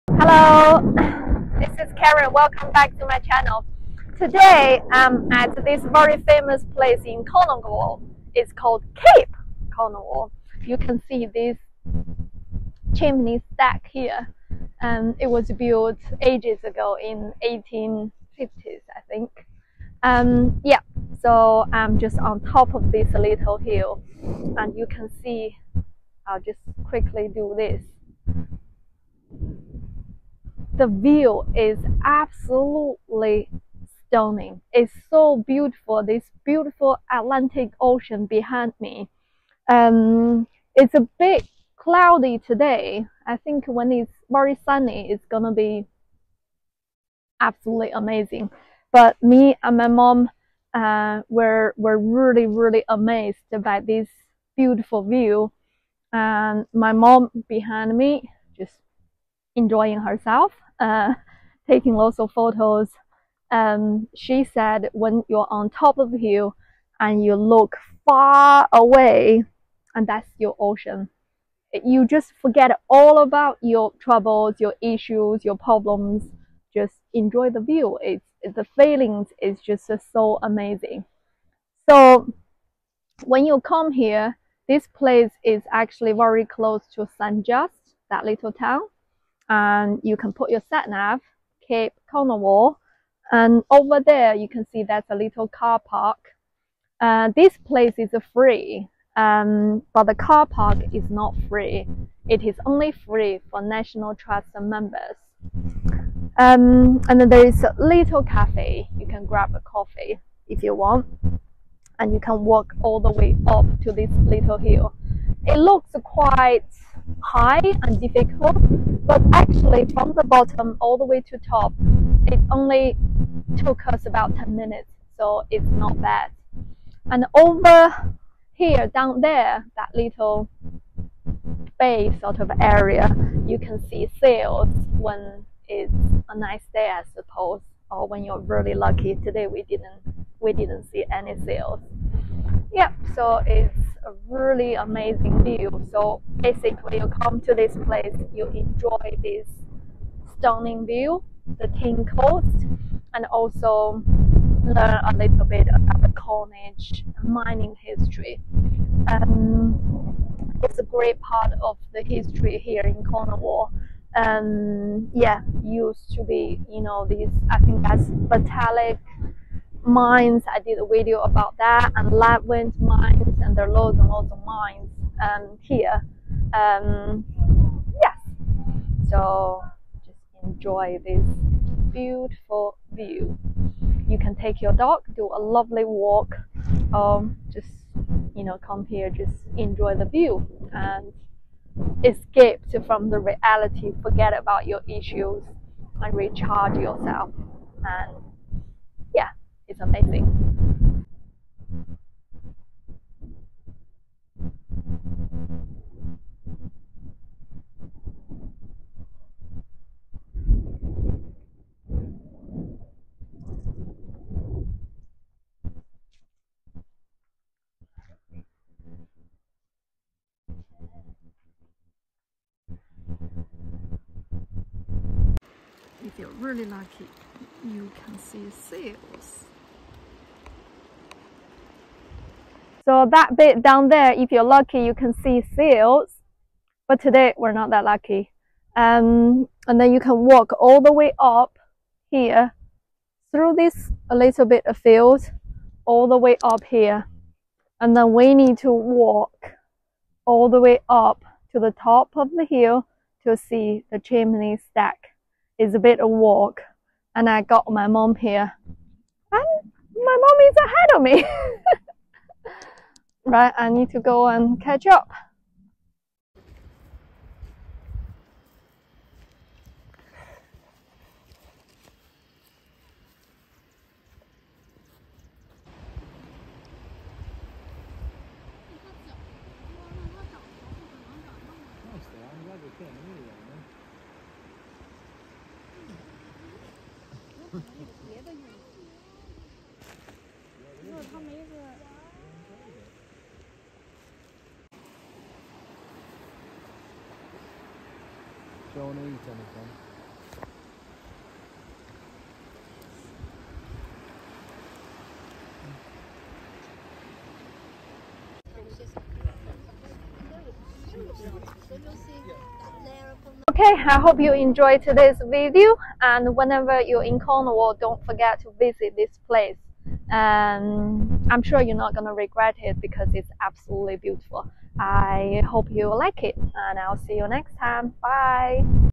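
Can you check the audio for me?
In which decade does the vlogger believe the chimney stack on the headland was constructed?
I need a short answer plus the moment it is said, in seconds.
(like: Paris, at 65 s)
1850s, at 17 s.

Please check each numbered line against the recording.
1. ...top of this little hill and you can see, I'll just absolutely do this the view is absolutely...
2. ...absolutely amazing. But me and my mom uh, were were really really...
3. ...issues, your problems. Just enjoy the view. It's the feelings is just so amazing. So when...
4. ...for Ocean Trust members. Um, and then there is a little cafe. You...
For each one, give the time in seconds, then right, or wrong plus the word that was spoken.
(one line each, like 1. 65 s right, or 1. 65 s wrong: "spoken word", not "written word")
1. 22 s wrong: "quickly", not "absolutely"
2. 47 s right
3. 74 s right
4. 103 s wrong: "National", not "Ocean".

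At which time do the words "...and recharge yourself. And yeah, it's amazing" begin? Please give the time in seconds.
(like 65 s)
196 s.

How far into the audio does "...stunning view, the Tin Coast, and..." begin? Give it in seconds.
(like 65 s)
150 s.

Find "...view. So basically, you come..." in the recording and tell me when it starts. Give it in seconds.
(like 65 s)
145 s.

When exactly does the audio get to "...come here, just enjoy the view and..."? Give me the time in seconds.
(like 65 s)
188 s.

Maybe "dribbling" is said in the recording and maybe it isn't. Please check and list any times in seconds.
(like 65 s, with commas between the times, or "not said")
not said.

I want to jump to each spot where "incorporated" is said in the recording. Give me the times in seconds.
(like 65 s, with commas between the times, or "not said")
not said.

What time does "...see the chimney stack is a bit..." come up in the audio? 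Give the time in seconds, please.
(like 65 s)
253 s.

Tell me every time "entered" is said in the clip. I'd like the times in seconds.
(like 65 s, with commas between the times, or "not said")
not said.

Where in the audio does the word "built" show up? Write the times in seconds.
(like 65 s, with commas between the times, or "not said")
15 s.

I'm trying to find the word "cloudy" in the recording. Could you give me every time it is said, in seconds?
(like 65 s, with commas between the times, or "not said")
41 s.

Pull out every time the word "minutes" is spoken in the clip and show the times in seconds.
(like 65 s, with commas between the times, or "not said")
124 s.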